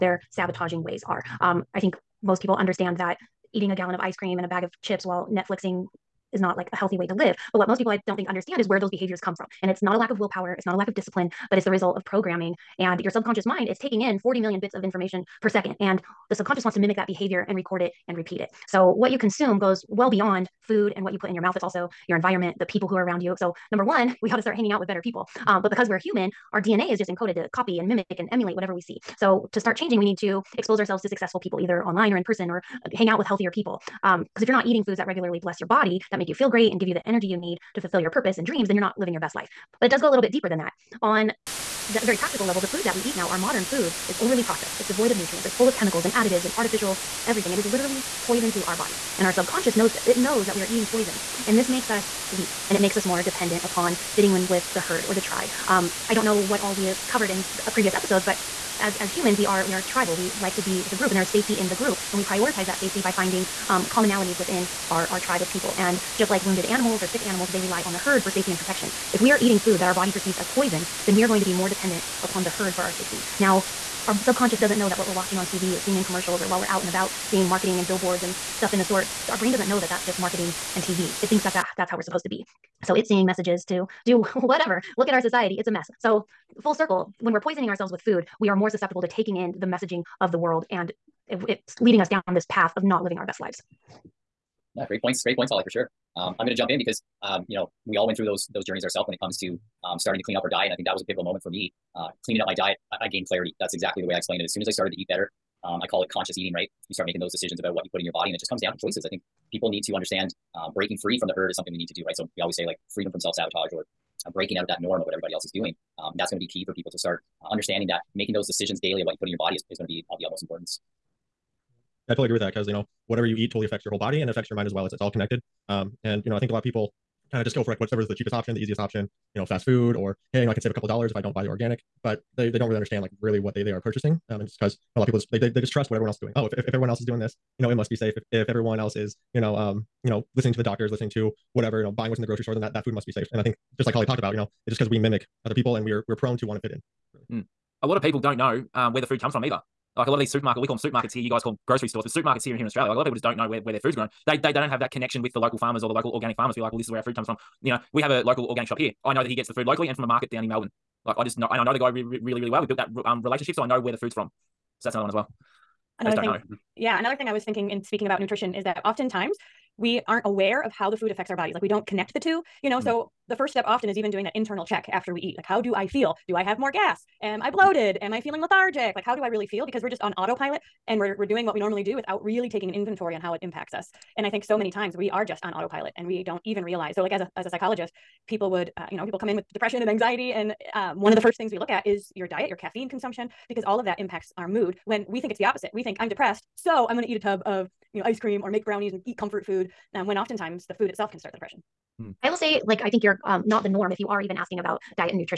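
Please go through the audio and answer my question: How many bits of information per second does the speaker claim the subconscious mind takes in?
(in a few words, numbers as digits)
40 million.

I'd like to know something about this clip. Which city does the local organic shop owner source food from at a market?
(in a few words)
Melbourne.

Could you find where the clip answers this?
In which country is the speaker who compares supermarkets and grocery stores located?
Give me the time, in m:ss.
2:32.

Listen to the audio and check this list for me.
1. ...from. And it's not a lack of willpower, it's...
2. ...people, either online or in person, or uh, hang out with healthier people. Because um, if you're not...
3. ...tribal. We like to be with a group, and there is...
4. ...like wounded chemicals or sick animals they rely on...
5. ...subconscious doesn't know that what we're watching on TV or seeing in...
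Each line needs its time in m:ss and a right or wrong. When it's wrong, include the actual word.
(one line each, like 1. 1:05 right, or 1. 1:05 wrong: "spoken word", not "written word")
1. 0:09 right
2. 0:31 right
3. 0:59 right
4. 1:06 wrong: "animals", not "chemicals"
5. 1:14 right.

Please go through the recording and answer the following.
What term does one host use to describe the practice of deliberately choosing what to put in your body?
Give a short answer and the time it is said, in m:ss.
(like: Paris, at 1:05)
conscious eating, at 1:46.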